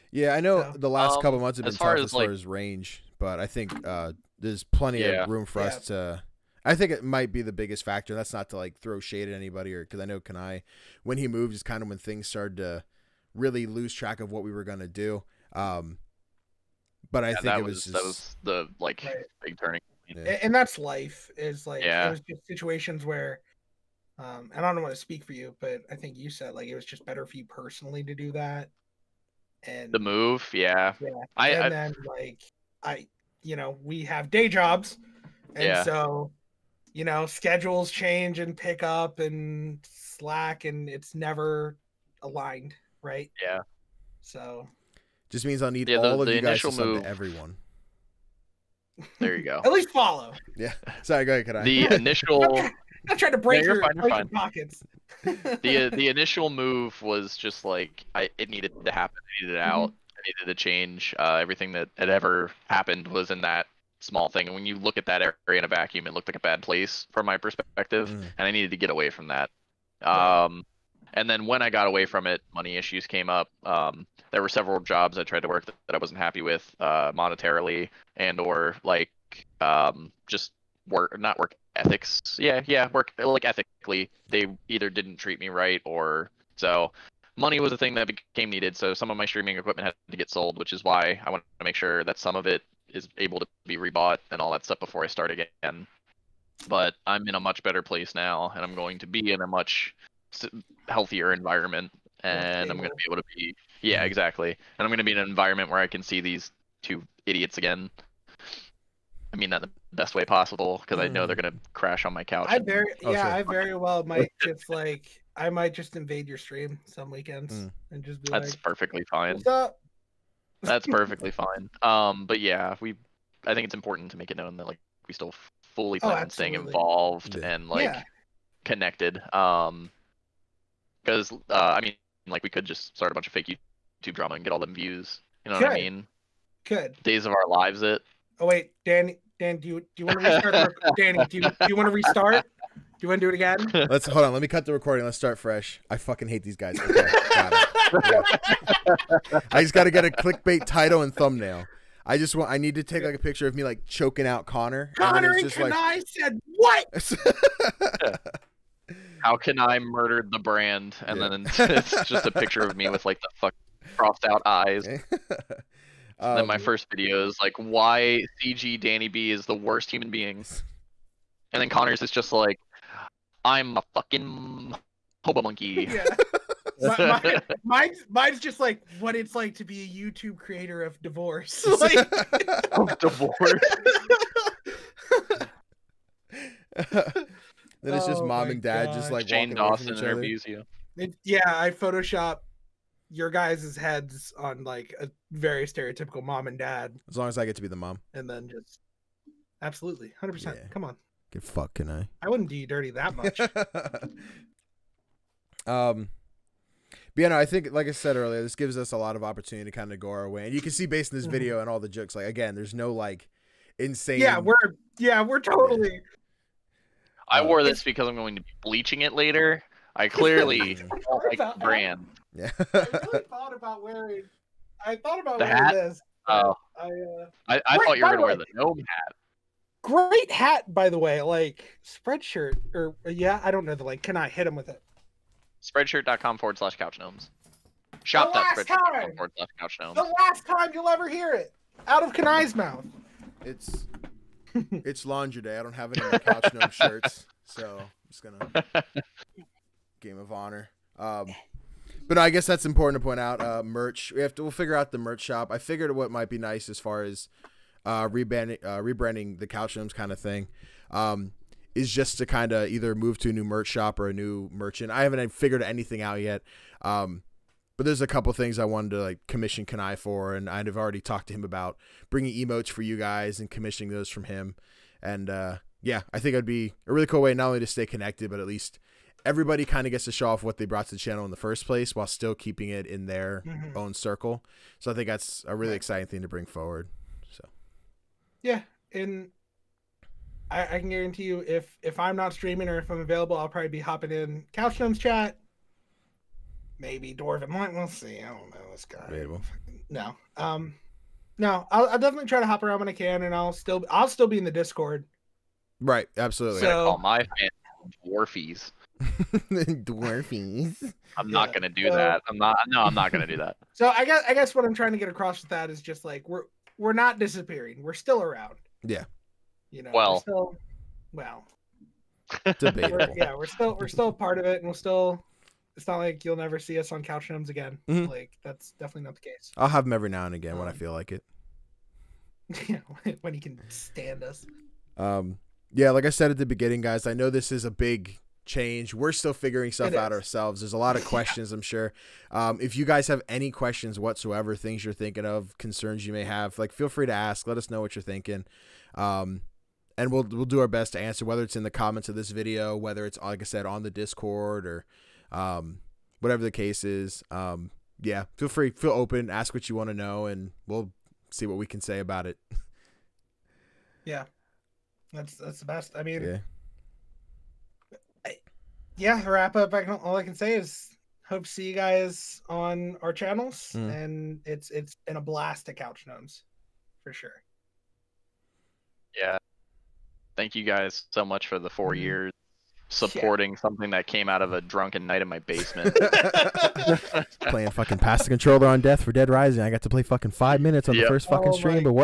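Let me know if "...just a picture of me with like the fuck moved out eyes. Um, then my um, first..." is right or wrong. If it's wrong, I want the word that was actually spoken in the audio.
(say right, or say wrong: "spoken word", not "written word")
wrong: "crossed", not "moved".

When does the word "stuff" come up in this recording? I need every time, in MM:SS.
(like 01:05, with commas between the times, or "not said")
01:34, 05:39.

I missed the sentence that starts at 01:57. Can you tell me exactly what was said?
and just be that's like, perfectly fine.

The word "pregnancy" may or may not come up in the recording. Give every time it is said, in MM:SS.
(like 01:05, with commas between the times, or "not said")
not said.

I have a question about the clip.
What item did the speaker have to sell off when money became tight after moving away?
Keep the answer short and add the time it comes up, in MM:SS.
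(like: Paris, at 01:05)
Streaming equipment, at 01:29.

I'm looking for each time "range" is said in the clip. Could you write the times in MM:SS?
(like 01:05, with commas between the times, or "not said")
00:02.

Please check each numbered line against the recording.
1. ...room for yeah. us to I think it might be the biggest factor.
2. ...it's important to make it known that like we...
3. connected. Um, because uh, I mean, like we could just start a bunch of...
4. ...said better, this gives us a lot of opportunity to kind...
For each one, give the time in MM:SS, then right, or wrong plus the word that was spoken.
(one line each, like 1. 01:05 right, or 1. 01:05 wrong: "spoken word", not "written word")
1. 00:05 right
2. 02:03 right
3. 02:08 right
4. 03:27 wrong: "earlier", not "better".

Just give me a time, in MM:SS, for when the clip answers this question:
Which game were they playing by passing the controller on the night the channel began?
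06:29.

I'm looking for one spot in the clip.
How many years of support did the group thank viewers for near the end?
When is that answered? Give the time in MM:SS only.
06:21.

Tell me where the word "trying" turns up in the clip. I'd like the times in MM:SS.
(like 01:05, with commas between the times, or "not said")
00:53, 05:14.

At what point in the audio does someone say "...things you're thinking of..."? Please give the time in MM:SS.
05:44.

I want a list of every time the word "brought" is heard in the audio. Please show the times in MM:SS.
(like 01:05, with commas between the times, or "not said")
04:40.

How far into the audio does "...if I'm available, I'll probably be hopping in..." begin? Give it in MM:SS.
04:52.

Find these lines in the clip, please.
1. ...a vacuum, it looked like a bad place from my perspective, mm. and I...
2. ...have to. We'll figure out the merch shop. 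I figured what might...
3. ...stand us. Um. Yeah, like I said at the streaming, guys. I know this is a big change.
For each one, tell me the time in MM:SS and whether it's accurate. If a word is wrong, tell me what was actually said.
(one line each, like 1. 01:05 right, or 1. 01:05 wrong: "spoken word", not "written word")
1. 01:05 right
2. 04:14 right
3. 05:33 wrong: "beginning", not "streaming".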